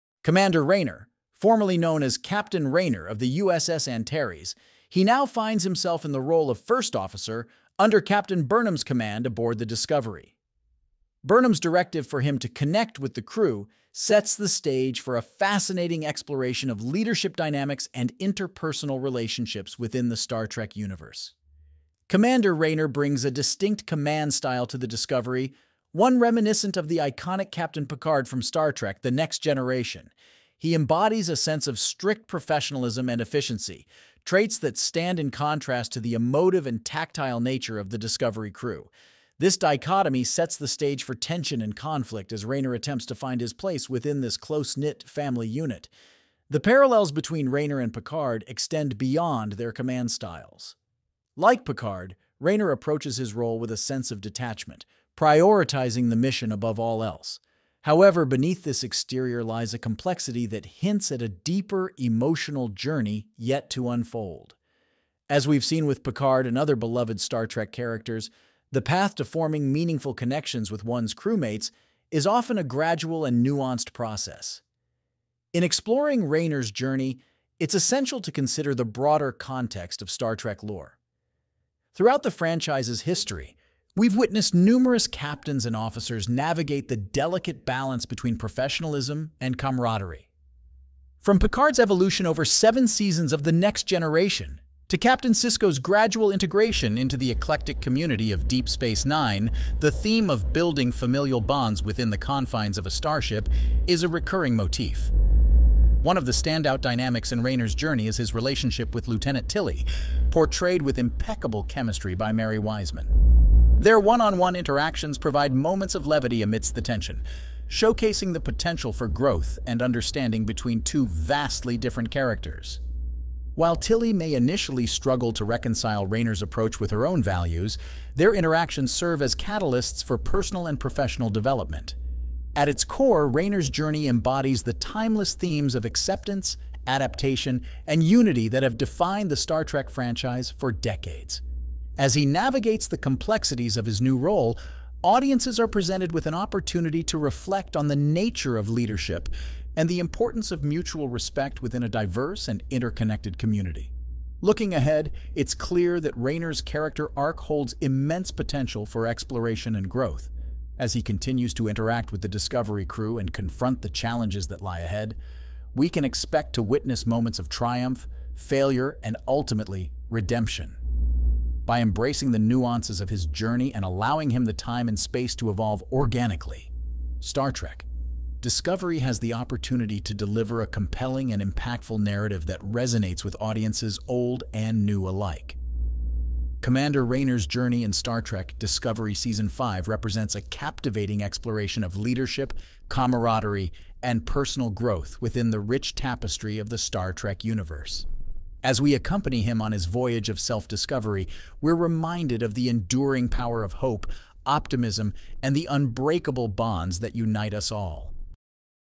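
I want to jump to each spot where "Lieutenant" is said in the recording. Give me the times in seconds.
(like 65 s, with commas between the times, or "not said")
109 s.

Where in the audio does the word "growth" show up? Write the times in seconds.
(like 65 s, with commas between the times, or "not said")
119 s, 159 s, 194 s.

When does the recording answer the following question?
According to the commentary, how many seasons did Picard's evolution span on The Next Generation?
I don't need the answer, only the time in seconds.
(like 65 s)
92 s.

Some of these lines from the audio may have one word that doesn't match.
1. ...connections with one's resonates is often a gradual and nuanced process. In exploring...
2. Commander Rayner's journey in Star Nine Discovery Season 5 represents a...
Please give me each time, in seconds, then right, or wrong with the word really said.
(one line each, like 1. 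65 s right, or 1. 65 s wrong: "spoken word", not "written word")
1. 70 s wrong: "crewmates", not "resonates"
2. 186 s wrong: "Trek", not "Nine".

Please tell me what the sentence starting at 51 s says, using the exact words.
Like Picard, Rayner approaches his role with a sense of detachment, prioritizing the mission above all else.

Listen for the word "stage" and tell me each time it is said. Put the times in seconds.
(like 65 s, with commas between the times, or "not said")
14 s, 40 s.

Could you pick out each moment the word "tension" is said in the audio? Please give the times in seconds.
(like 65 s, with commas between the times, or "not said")
41 s, 116 s.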